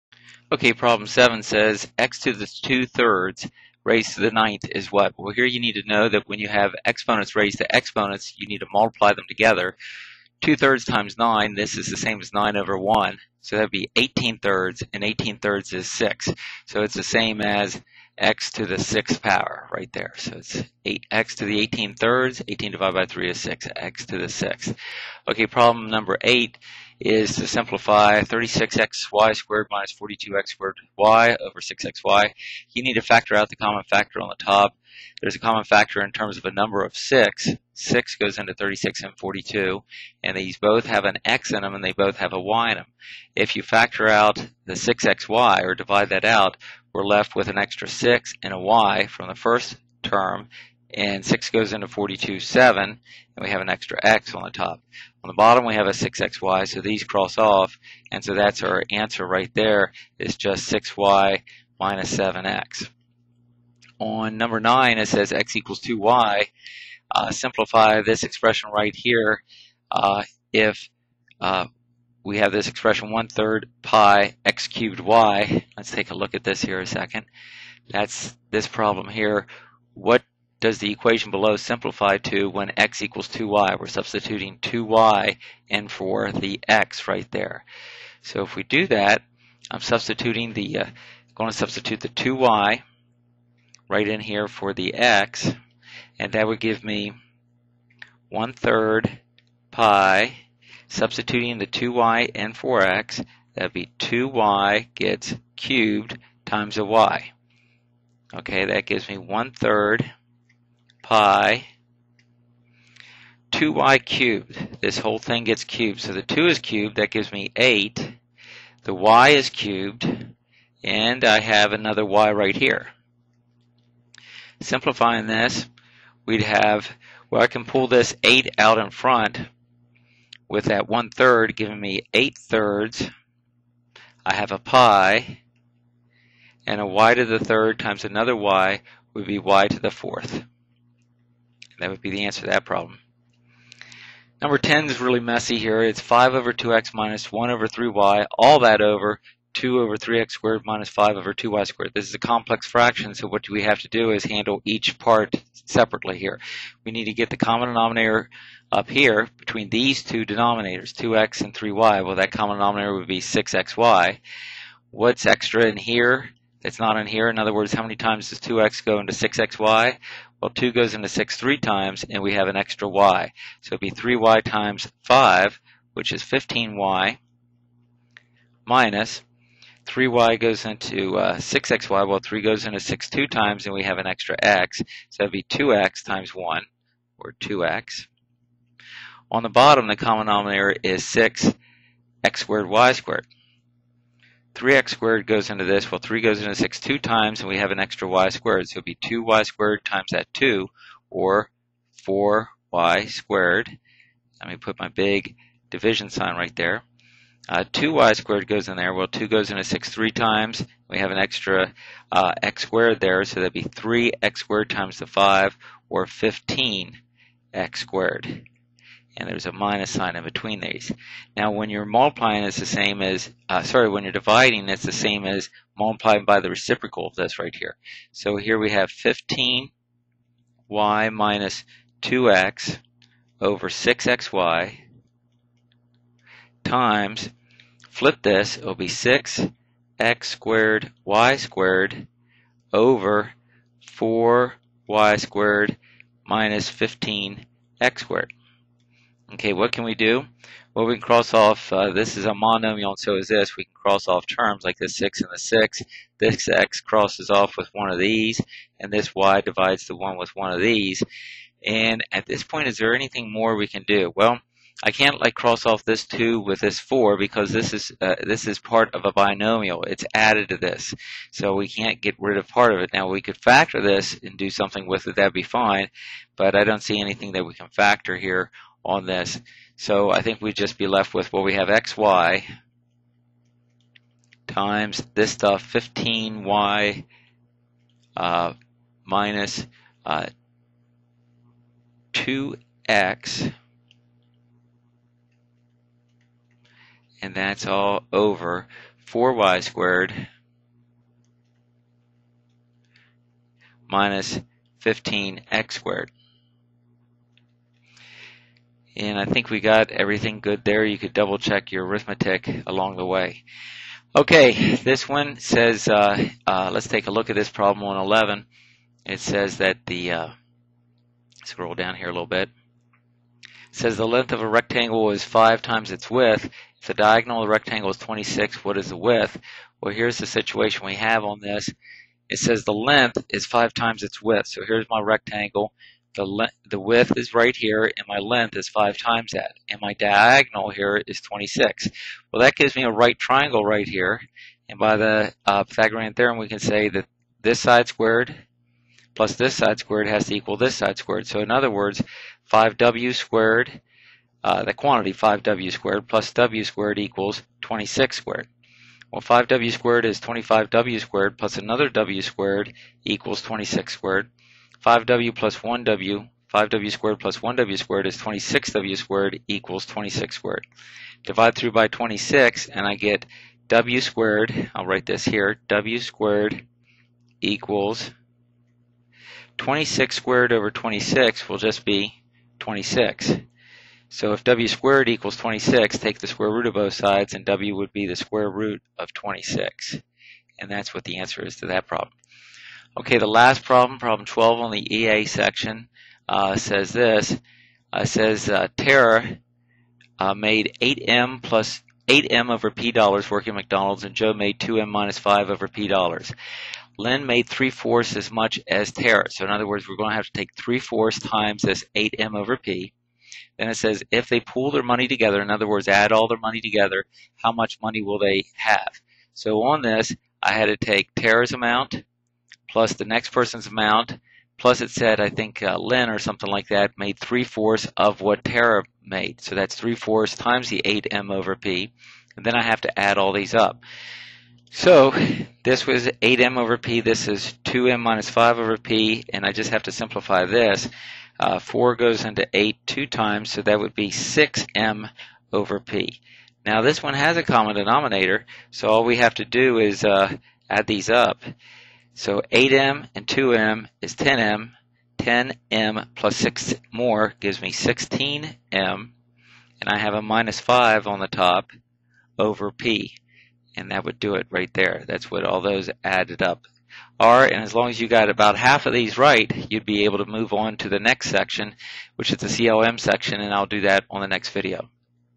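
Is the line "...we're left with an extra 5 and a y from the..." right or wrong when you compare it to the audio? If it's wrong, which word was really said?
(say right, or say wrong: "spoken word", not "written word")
wrong: "6", not "5".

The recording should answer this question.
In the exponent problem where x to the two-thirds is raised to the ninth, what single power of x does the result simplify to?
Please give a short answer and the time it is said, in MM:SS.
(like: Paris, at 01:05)
x to the 6th, at 00:18.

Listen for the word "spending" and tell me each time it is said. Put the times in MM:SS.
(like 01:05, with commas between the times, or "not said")
not said.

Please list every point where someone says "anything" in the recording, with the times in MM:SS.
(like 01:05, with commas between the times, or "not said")
04:22, 04:36.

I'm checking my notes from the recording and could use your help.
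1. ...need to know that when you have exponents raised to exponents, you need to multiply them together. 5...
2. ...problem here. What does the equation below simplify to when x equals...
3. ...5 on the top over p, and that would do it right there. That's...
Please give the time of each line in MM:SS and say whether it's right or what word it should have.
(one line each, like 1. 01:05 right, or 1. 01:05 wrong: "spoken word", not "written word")
1. 00:05 wrong: "2", not "5"
2. 01:18 right
3. 07:40 right.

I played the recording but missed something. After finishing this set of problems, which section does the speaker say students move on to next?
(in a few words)
CLM section.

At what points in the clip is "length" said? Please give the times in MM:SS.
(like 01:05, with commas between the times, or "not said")
05:24, 05:32, 05:38.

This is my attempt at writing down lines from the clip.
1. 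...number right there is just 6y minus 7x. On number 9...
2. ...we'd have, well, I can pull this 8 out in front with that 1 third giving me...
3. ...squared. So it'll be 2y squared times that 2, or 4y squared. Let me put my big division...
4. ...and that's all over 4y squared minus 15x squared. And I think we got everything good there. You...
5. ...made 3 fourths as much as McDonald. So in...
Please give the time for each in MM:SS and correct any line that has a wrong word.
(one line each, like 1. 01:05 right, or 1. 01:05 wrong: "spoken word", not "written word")
1. 00:58 wrong: "answer", not "number"
2. 02:06 right
3. 03:18 right
4. 04:57 right
5. 06:47 wrong: "Tara", not "McDonald".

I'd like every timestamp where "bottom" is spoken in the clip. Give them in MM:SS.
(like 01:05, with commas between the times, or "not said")
00:55, 03:09.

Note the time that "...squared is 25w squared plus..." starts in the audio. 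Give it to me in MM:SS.
05:59.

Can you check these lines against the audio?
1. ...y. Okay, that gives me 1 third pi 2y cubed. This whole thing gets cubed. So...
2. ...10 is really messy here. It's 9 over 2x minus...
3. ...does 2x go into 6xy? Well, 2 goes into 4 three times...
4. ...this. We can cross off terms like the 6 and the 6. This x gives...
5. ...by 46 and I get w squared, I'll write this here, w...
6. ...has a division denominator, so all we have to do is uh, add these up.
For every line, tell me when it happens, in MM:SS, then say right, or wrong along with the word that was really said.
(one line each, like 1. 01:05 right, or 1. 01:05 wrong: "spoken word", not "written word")
1. 01:46 right
2. 02:24 wrong: "5", not "9"
3. 02:48 wrong: "6", not "4"
4. 04:13 wrong: "crosses", not "gives"
5. 06:11 wrong: "26", not "46"
6. 07:27 wrong: "common", not "division".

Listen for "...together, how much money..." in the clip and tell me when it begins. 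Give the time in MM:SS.
06:56.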